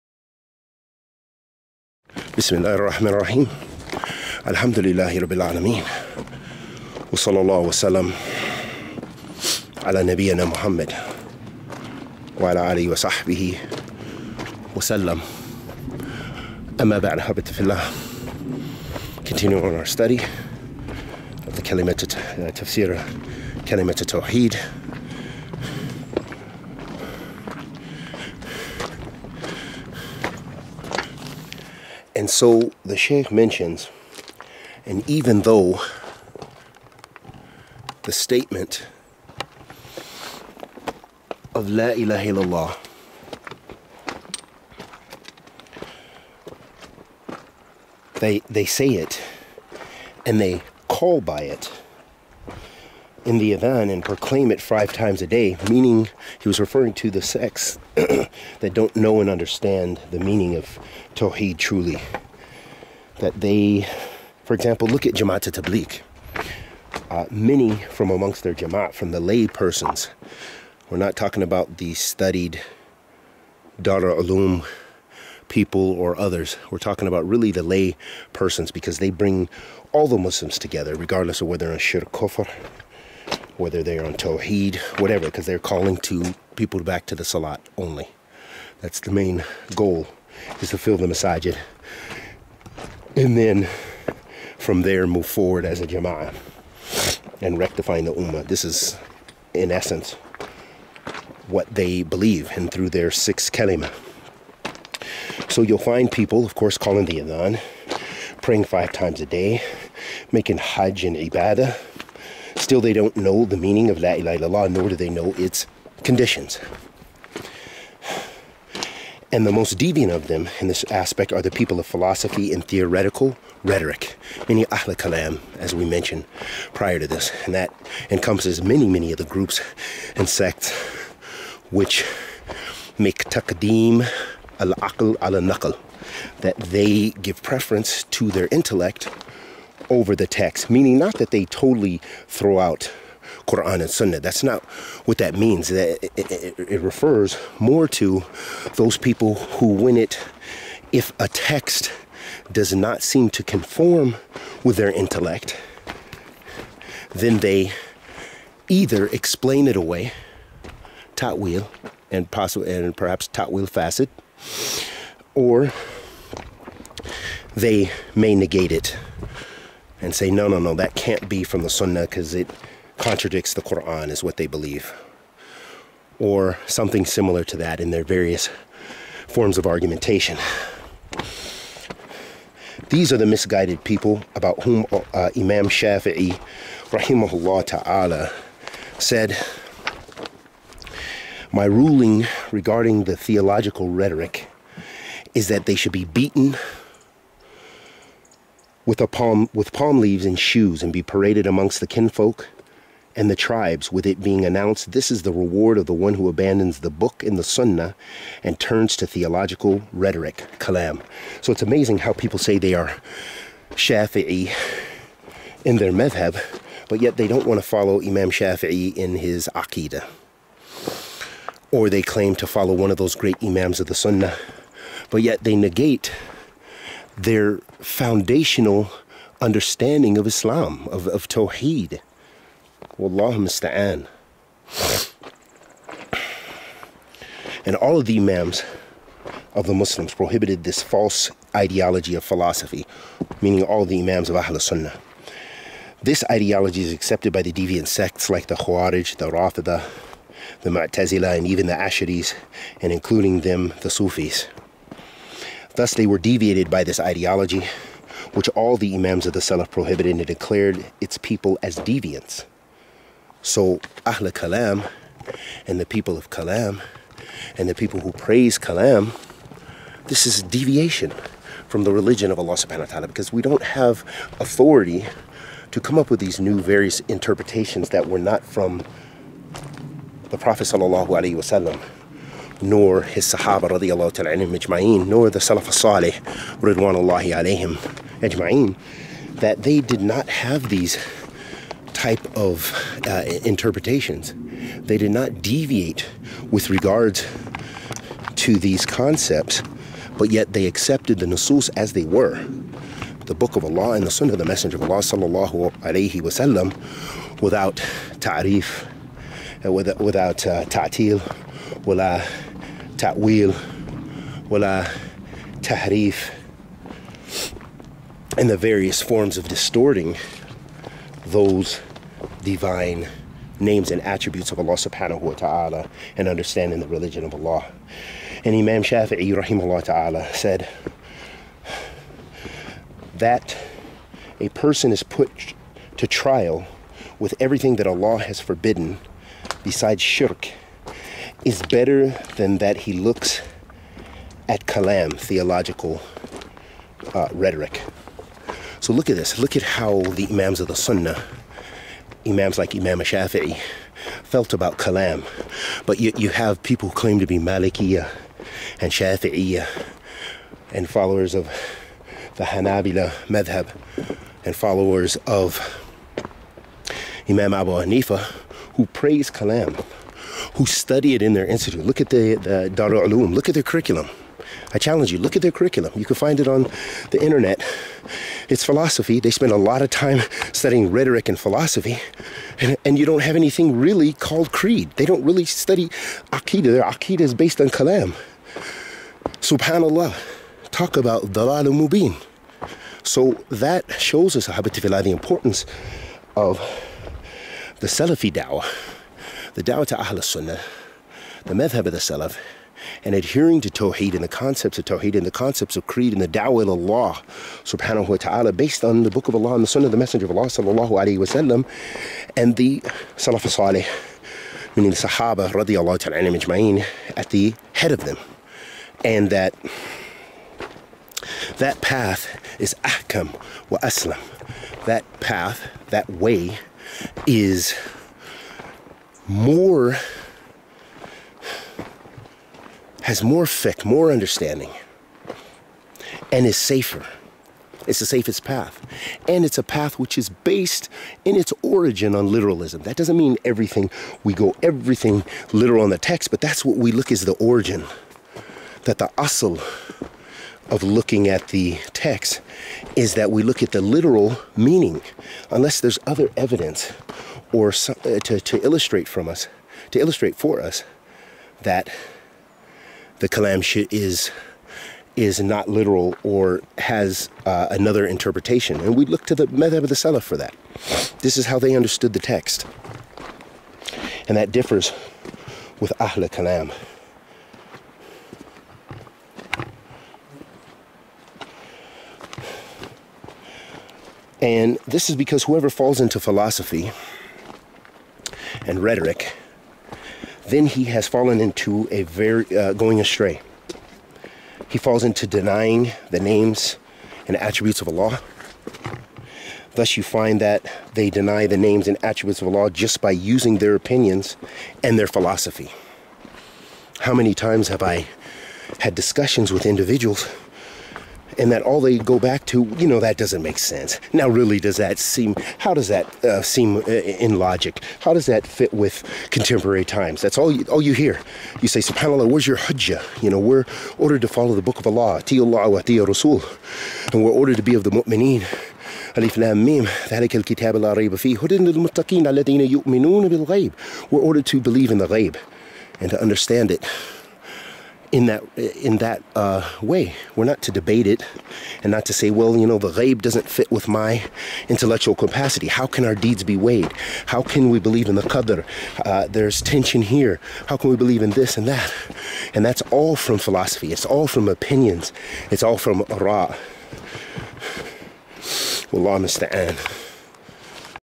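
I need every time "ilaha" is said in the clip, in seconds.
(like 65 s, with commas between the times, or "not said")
41 s, 114 s.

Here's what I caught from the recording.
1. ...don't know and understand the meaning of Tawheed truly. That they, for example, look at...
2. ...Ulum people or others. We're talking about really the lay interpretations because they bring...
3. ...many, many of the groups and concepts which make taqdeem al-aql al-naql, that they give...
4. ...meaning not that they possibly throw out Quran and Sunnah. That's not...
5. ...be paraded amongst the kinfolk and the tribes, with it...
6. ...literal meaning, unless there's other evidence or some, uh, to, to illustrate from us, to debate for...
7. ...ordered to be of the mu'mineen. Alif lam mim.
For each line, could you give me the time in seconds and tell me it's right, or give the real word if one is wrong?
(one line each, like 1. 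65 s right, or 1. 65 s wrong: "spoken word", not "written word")
1. 58 s right
2. 74 s wrong: "persons", not "interpretations"
3. 128 s wrong: "sects", not "concepts"
4. 140 s wrong: "totally", not "possibly"
5. 200 s right
6. 453 s wrong: "illustrate", not "debate"
7. 527 s right.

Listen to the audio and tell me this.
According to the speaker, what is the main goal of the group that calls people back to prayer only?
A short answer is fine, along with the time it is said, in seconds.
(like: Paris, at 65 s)
To fill the masajid, at 90 s.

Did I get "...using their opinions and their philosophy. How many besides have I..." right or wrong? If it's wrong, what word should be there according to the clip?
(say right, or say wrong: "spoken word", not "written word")
wrong: "times", not "besides".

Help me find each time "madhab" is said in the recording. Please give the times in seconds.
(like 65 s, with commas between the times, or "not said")
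215 s, 363 s, 401 s, 469 s.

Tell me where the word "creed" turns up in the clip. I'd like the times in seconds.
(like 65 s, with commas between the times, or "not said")
384 s, 405 s.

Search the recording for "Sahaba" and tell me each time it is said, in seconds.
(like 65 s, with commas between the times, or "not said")
283 s, 414 s.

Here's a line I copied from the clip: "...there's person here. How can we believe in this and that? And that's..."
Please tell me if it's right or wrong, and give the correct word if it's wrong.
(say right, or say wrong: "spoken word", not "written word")
wrong: "tension", not "person".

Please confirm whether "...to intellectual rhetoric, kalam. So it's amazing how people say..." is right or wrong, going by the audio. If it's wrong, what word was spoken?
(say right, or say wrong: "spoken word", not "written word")
wrong: "theological", not "intellectual".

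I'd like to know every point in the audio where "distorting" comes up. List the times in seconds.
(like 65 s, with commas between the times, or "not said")
319 s.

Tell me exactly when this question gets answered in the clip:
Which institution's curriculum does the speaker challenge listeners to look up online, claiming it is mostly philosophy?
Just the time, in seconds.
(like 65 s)
372 s.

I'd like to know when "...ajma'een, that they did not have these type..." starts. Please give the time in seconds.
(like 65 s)
288 s.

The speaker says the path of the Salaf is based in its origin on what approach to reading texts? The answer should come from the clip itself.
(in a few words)
Literalism.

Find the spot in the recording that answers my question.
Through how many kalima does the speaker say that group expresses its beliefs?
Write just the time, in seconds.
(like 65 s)
103 s.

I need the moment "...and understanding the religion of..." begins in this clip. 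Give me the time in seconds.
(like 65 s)
326 s.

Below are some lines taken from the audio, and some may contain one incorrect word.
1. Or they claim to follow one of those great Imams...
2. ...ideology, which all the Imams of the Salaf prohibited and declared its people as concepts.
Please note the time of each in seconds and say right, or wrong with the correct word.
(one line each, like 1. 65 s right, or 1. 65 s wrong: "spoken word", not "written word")
1. 221 s right
2. 256 s wrong: "deviants", not "concepts".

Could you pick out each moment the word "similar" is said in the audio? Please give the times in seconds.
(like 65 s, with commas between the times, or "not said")
177 s.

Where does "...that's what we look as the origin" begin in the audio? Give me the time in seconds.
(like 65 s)
446 s.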